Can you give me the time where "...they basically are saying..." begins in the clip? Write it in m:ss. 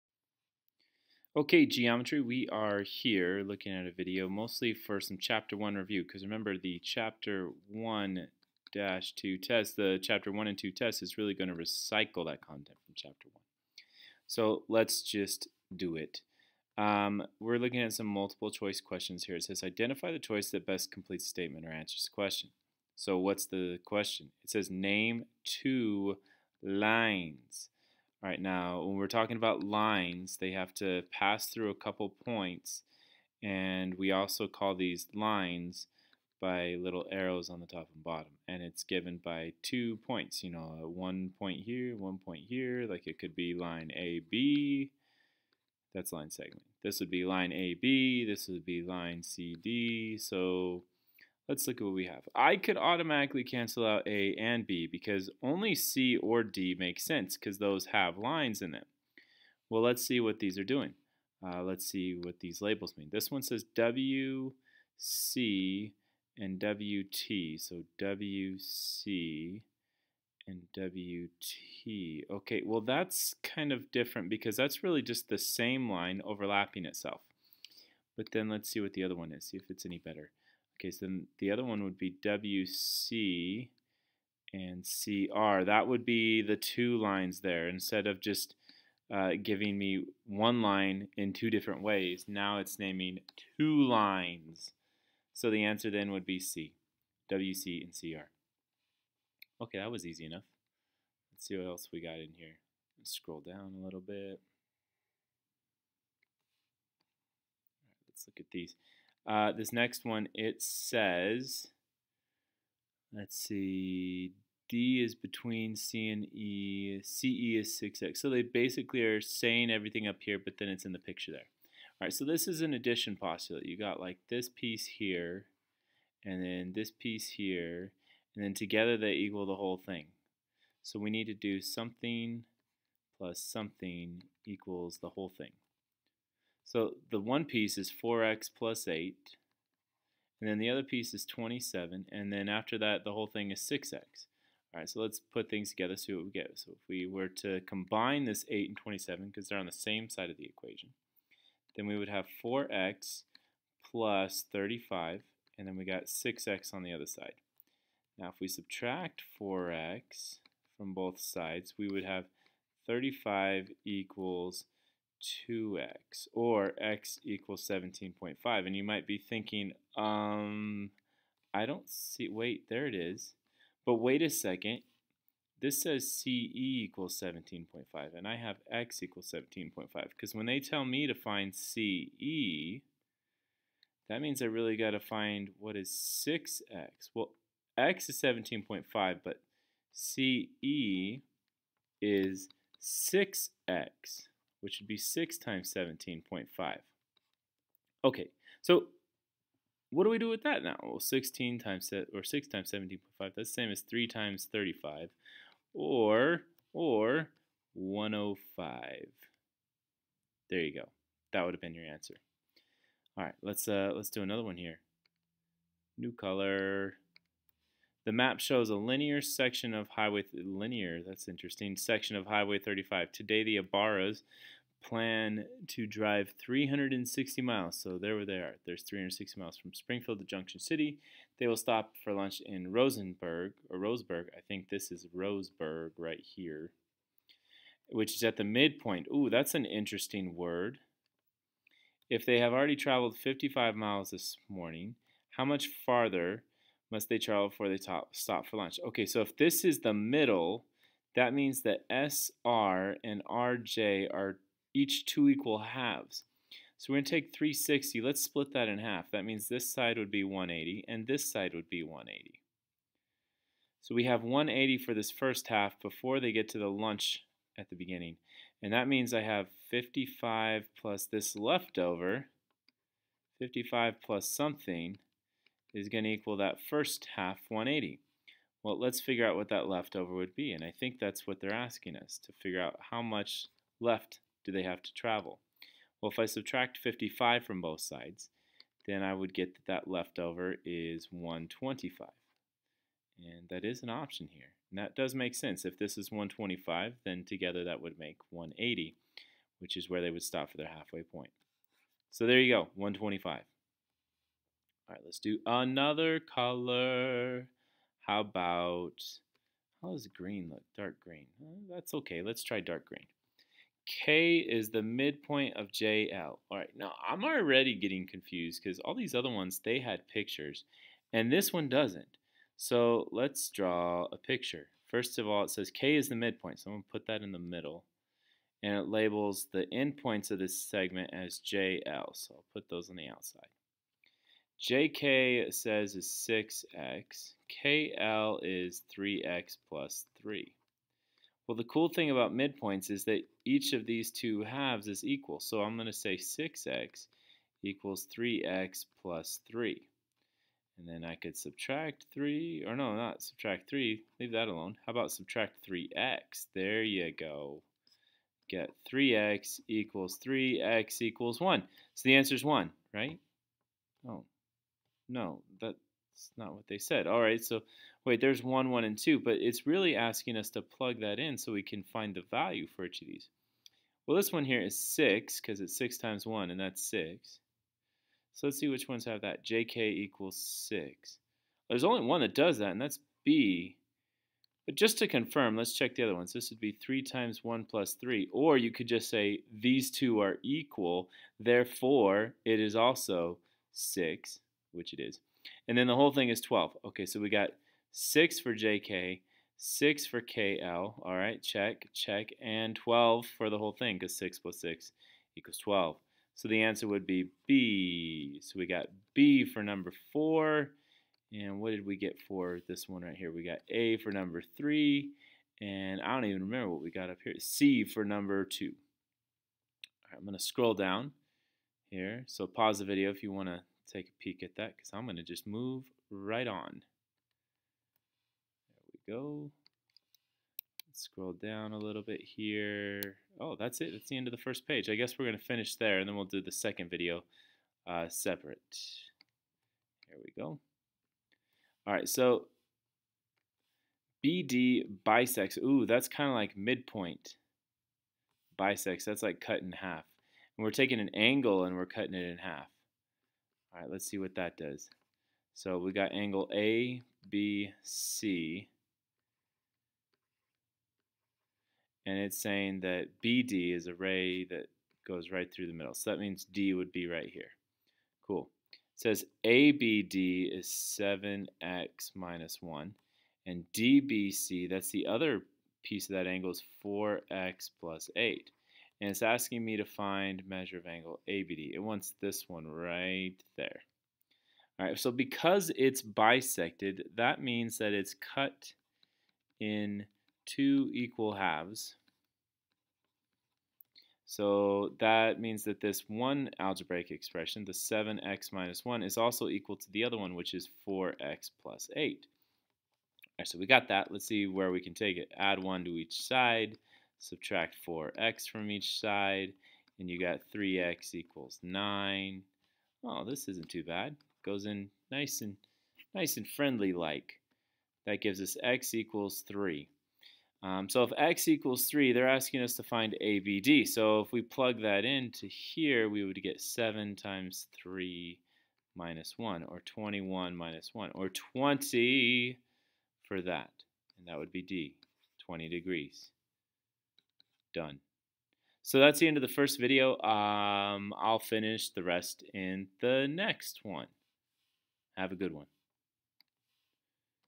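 1:58.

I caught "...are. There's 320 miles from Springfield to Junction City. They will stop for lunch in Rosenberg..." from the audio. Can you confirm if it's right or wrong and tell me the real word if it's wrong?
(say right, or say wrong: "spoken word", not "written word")
wrong: "360", not "320".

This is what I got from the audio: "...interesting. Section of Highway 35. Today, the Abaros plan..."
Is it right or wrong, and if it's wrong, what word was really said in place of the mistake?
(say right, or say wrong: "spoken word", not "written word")
right.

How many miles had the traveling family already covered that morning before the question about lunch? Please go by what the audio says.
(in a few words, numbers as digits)
55.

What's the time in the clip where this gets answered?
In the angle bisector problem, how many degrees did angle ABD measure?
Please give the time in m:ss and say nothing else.
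8:55.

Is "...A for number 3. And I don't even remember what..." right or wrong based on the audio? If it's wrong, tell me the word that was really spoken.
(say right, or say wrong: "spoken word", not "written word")
right.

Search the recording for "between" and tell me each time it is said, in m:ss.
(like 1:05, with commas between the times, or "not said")
1:55.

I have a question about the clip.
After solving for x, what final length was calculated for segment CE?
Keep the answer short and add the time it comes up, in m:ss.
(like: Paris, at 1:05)
105, at 3:27.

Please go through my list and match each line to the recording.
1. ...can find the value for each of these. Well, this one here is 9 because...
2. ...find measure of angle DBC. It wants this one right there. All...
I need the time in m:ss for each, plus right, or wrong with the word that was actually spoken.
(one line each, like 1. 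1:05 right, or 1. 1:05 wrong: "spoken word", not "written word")
1. 6:11 wrong: "6", not "9"
2. 7:59 wrong: "ABD", not "DBC".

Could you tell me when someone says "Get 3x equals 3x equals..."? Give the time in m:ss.
5:58.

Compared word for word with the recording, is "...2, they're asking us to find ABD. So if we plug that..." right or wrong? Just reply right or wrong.
wrong.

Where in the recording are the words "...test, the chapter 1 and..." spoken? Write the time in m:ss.
0:09.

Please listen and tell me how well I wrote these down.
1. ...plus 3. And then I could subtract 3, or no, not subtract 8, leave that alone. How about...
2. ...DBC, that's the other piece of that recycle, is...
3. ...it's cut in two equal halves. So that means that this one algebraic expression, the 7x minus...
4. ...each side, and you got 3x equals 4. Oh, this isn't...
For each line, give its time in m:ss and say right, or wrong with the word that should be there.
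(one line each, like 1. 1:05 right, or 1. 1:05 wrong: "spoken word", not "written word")
1. 5:49 wrong: "3", not "8"
2. 7:53 wrong: "angle", not "recycle"
3. 8:07 right
4. 8:28 wrong: "9", not "4".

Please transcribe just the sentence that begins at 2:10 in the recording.
So we need to do something plus something equals the whole thing.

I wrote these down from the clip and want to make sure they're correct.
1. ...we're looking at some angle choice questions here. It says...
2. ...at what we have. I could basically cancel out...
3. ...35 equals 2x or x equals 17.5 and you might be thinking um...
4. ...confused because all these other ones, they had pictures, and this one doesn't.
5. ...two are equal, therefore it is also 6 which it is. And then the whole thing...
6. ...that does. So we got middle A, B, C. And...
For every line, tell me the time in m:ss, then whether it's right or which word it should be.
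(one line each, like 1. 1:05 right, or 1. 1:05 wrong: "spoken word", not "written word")
1. 0:17 wrong: "multiple", not "angle"
2. 0:51 wrong: "automatically", not "basically"
3. 2:42 right
4. 5:18 right
5. 6:29 right
6. 7:34 wrong: "angle", not "middle".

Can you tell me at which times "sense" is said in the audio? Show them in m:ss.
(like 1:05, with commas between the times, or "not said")
0:57, 4:55.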